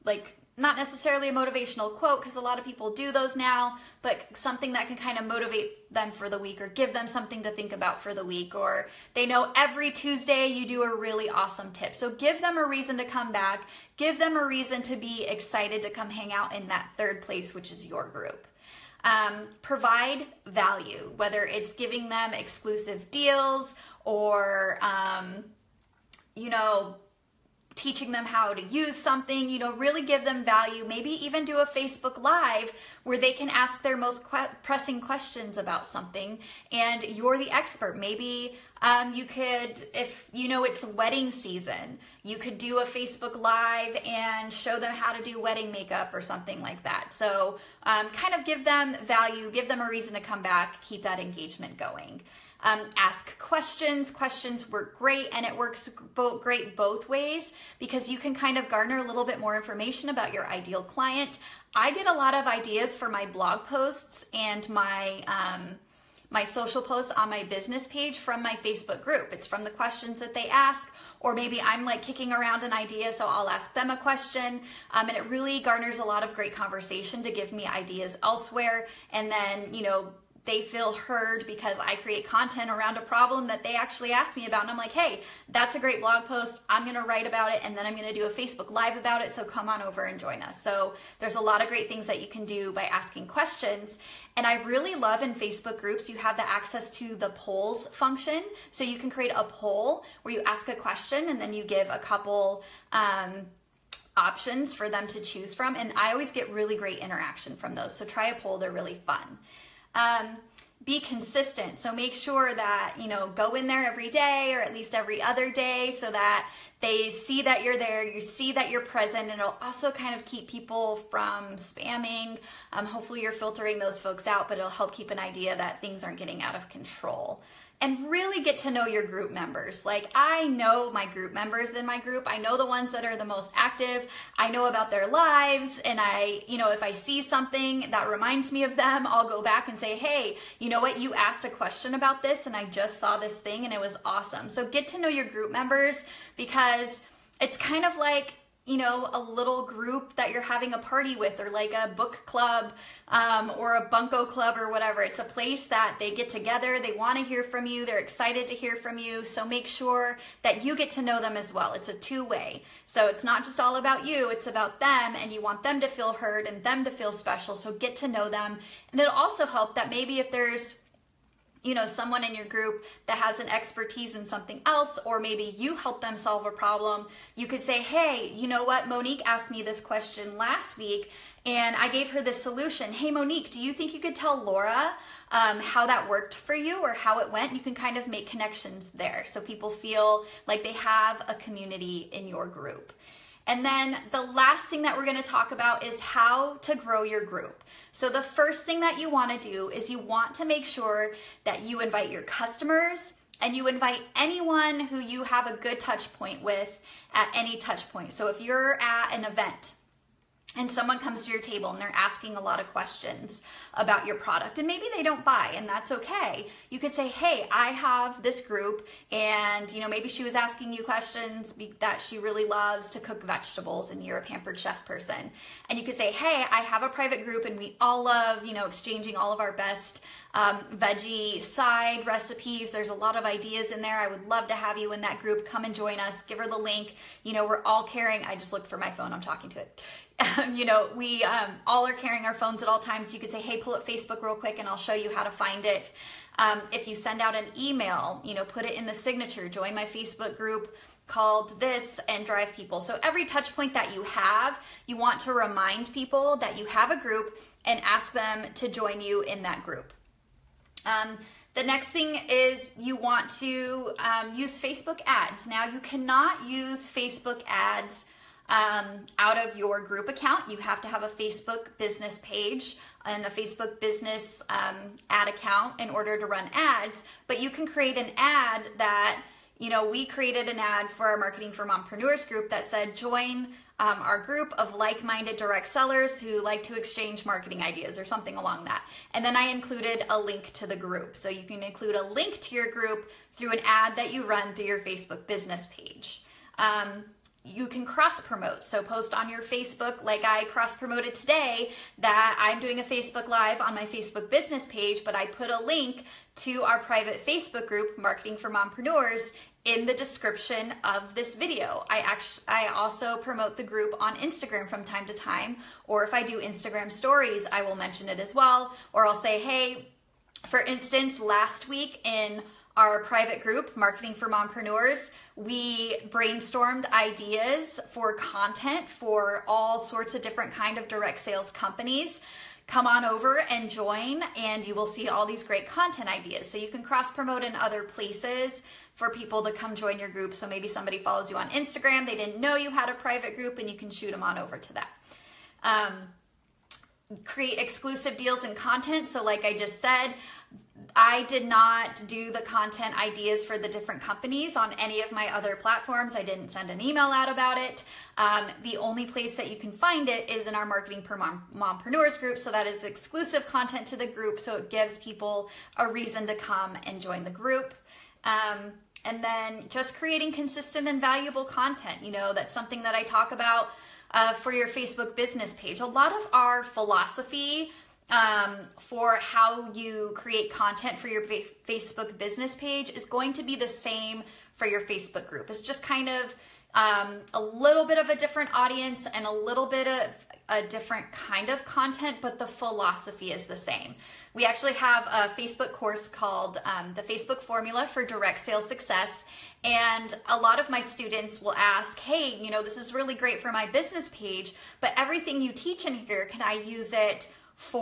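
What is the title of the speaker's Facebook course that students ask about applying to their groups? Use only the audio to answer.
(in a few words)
The Facebook Formula for Direct Sales Success.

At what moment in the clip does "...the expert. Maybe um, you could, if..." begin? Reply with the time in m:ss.
0:37.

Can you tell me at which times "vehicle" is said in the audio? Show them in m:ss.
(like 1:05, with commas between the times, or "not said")
not said.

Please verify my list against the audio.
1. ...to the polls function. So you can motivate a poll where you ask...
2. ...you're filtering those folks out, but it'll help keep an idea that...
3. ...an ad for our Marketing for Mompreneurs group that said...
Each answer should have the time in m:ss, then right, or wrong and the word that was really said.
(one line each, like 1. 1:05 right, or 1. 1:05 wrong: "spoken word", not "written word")
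1. 1:36 wrong: "create", not "motivate"
2. 2:03 right
3. 4:40 right.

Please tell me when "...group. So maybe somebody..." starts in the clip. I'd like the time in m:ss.
5:40.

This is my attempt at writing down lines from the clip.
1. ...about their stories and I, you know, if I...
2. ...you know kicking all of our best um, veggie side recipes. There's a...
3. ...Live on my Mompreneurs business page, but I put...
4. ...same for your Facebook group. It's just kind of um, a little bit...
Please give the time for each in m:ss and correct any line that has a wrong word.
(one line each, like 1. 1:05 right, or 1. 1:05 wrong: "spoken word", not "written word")
1. 2:14 wrong: "lives", not "stories"
2. 3:48 wrong: "exchanging", not "kicking"
3. 5:03 wrong: "Facebook", not "Mompreneurs"
4. 6:23 right.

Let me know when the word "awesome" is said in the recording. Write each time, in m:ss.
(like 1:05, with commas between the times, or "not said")
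0:11, 2:24.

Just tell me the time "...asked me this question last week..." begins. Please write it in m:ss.
2:59.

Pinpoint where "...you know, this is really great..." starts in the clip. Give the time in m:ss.
6:42.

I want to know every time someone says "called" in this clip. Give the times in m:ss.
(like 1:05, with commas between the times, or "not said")
4:11, 6:36.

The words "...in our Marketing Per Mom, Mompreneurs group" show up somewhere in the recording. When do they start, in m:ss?
6:00.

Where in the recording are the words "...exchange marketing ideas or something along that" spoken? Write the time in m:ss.
4:46.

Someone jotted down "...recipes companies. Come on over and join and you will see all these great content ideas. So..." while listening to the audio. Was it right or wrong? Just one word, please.
wrong.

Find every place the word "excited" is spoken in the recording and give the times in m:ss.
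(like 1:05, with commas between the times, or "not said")
0:15, 2:37.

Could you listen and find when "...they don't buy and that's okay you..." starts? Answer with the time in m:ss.
3:34.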